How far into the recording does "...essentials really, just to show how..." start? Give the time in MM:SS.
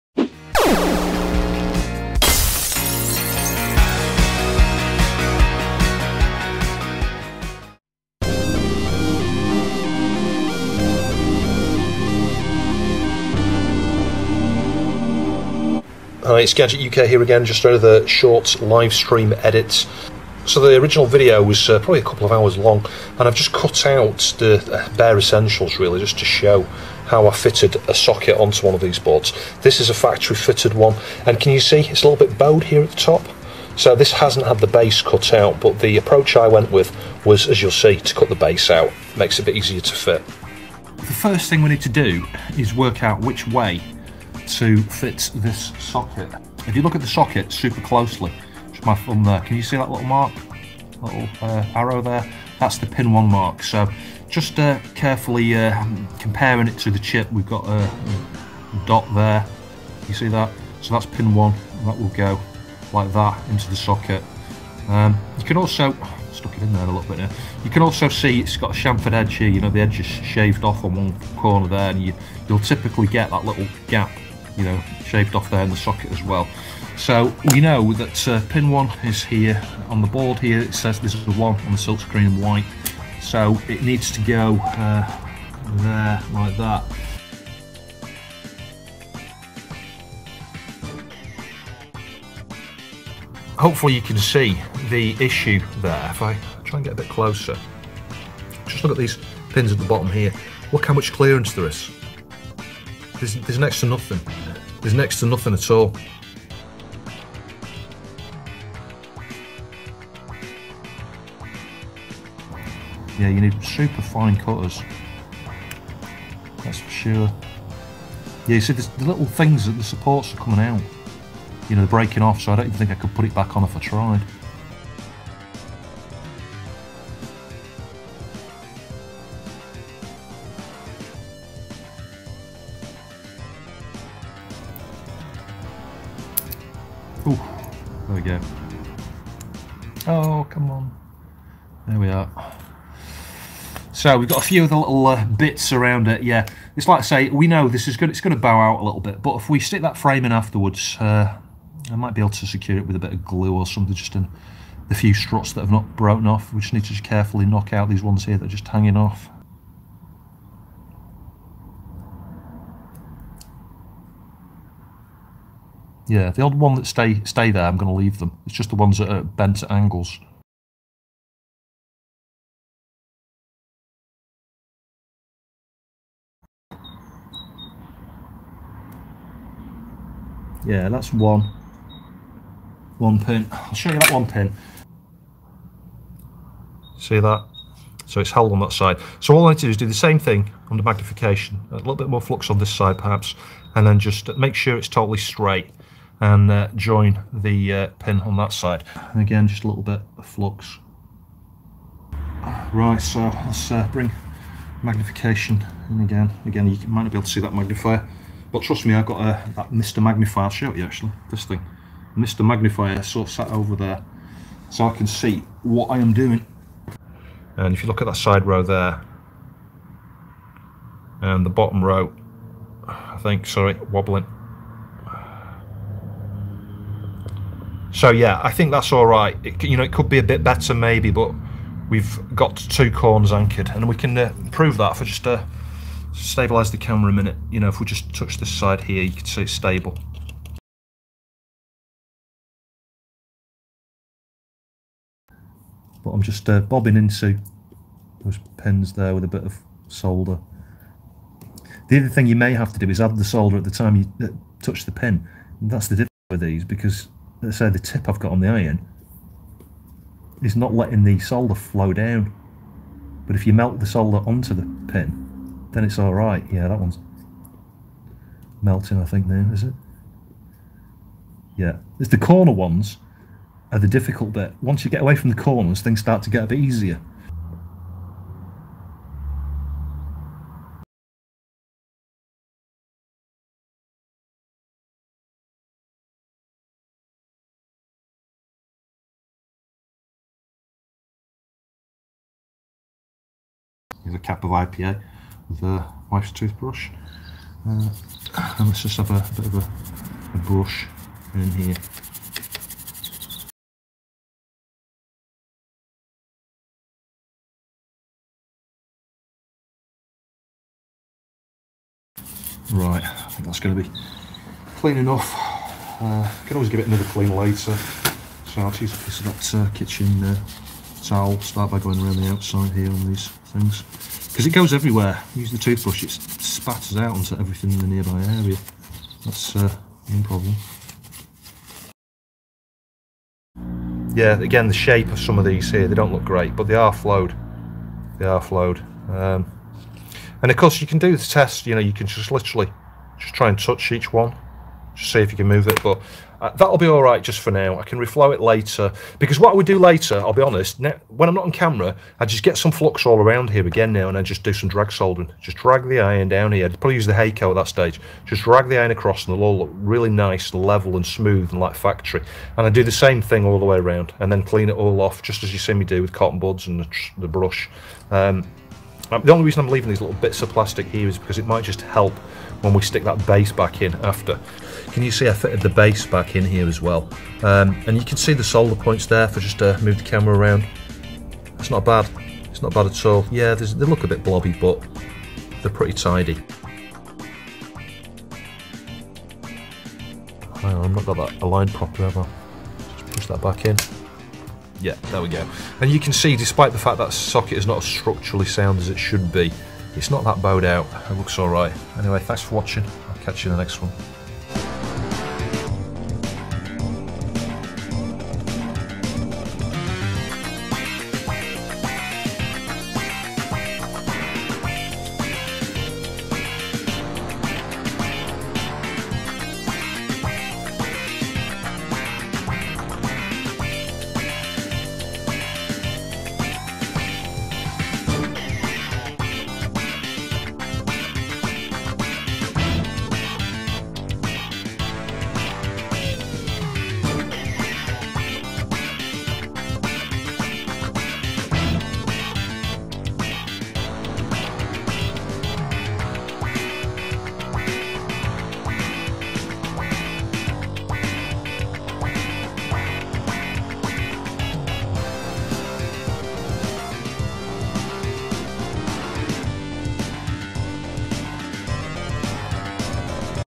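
00:25.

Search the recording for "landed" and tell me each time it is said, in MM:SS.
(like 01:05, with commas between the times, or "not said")
not said.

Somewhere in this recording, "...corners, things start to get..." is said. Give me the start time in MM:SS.
04:35.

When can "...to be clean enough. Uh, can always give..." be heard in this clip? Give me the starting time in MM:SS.
05:13.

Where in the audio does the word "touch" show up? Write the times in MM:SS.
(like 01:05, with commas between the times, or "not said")
03:58, 04:14, 05:43.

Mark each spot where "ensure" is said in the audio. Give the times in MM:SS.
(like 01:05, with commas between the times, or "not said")
not said.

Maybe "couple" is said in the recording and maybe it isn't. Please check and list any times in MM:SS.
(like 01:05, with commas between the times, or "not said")
00:22.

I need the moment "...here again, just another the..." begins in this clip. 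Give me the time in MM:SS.
00:17.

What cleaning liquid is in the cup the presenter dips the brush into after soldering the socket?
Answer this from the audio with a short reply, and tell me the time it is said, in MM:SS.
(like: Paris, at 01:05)
IPA, at 04:54.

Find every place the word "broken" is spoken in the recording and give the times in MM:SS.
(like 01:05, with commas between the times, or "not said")
02:35.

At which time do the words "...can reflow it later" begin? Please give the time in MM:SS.
05:47.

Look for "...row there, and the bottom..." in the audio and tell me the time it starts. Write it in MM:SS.
03:38.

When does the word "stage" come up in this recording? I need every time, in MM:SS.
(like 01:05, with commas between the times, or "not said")
05:57.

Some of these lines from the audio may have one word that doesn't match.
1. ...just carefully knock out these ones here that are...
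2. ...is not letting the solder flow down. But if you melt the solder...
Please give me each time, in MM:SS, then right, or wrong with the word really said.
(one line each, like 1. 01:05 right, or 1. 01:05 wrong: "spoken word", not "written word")
1. 02:36 right
2. 04:20 right.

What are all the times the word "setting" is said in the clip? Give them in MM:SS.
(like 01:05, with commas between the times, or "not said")
not said.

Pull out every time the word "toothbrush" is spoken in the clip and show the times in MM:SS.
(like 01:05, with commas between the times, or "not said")
04:56, 05:25.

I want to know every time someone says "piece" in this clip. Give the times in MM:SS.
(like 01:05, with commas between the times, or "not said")
05:19.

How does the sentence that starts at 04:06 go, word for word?
But I'm just uh, bobbing into those pins there with a bit of solder.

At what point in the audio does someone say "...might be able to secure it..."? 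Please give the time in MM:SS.
02:31.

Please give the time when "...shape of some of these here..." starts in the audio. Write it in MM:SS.
05:34.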